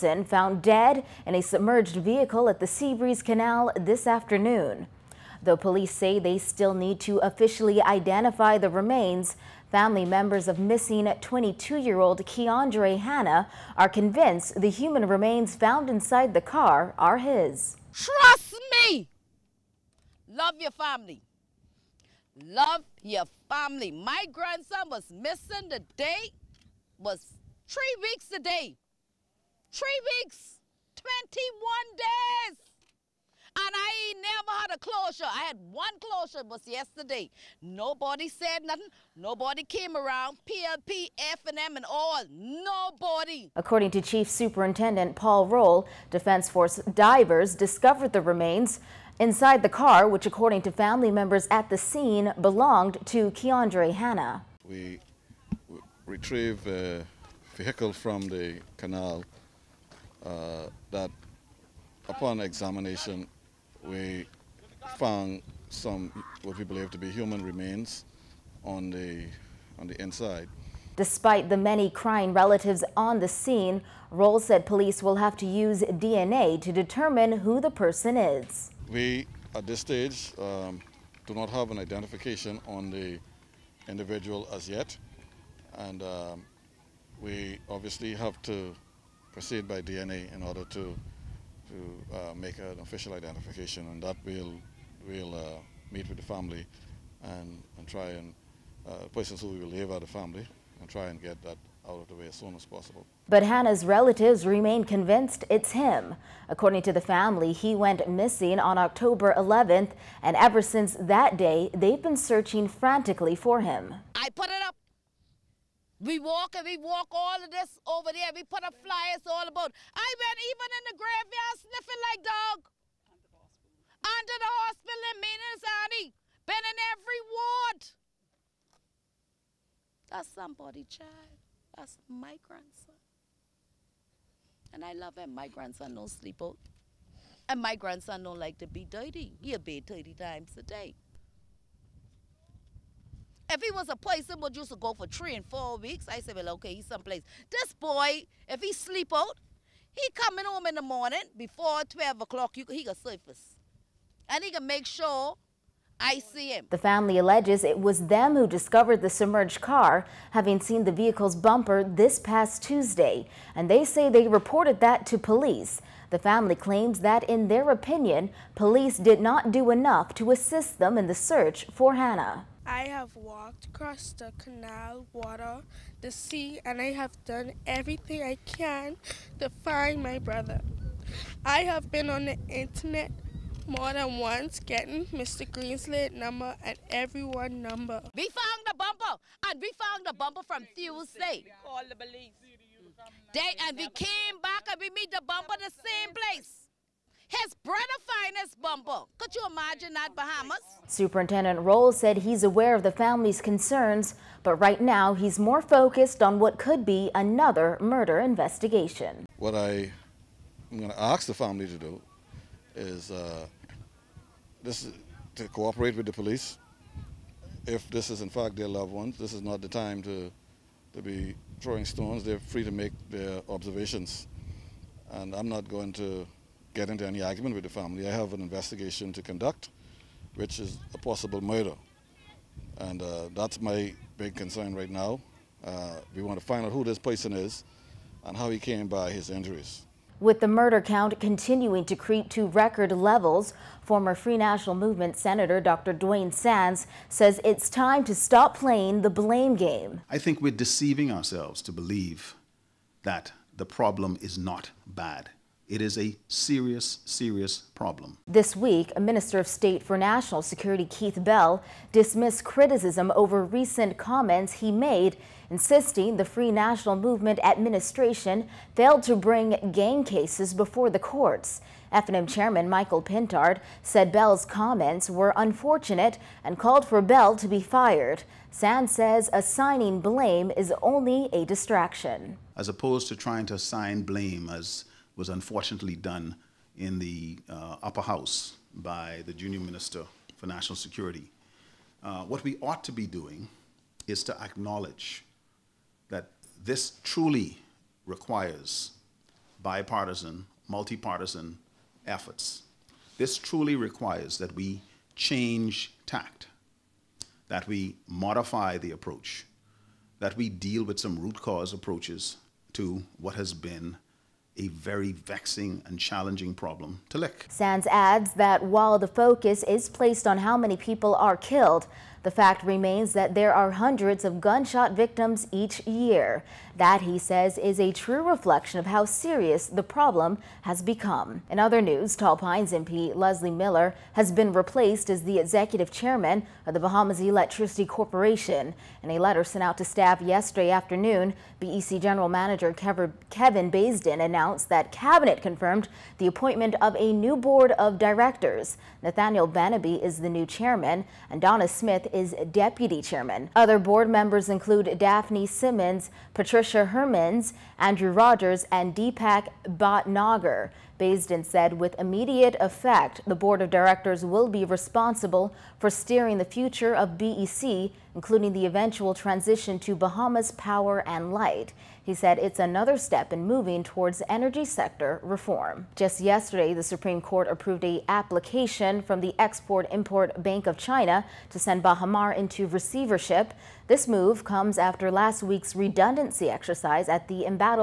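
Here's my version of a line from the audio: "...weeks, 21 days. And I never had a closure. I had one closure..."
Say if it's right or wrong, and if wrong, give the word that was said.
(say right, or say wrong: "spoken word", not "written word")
right.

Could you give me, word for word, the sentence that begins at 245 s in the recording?
Duane Sands says it's time to stop playing the blame game.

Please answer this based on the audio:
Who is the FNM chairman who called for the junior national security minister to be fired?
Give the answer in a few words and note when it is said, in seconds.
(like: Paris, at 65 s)
Michael Pintard, at 272 s.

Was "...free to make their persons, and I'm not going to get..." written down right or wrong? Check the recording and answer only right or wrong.
wrong.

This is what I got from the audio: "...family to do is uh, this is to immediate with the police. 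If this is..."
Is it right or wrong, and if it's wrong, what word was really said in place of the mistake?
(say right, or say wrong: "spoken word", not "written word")
wrong: "cooperate", not "immediate".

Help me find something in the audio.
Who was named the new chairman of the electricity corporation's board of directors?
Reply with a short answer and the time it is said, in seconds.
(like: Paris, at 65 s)
Nathaniel Banaby, at 349 s.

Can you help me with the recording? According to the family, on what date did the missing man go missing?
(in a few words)
October 11th.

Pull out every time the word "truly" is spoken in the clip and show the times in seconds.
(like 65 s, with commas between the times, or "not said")
297 s, 303 s.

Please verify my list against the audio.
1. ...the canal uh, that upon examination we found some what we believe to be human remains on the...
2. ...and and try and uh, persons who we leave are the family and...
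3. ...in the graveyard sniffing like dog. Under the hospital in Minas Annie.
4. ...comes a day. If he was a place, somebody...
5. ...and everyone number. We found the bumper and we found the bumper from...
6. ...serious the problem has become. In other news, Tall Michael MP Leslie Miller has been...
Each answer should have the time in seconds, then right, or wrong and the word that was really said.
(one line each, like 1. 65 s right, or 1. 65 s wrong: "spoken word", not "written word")
1. 58 s right
2. 97 s right
3. 120 s right
4. 140 s wrong: "times", not "comes"
5. 186 s right
6. 329 s wrong: "Pines", not "Michael".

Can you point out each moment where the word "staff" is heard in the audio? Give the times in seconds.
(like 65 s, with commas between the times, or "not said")
339 s.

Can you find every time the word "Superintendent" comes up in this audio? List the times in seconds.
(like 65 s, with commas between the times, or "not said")
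44 s, 200 s.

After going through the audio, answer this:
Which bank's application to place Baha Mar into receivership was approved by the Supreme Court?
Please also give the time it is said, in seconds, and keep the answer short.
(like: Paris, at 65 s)
Export-Import Bank of China, at 379 s.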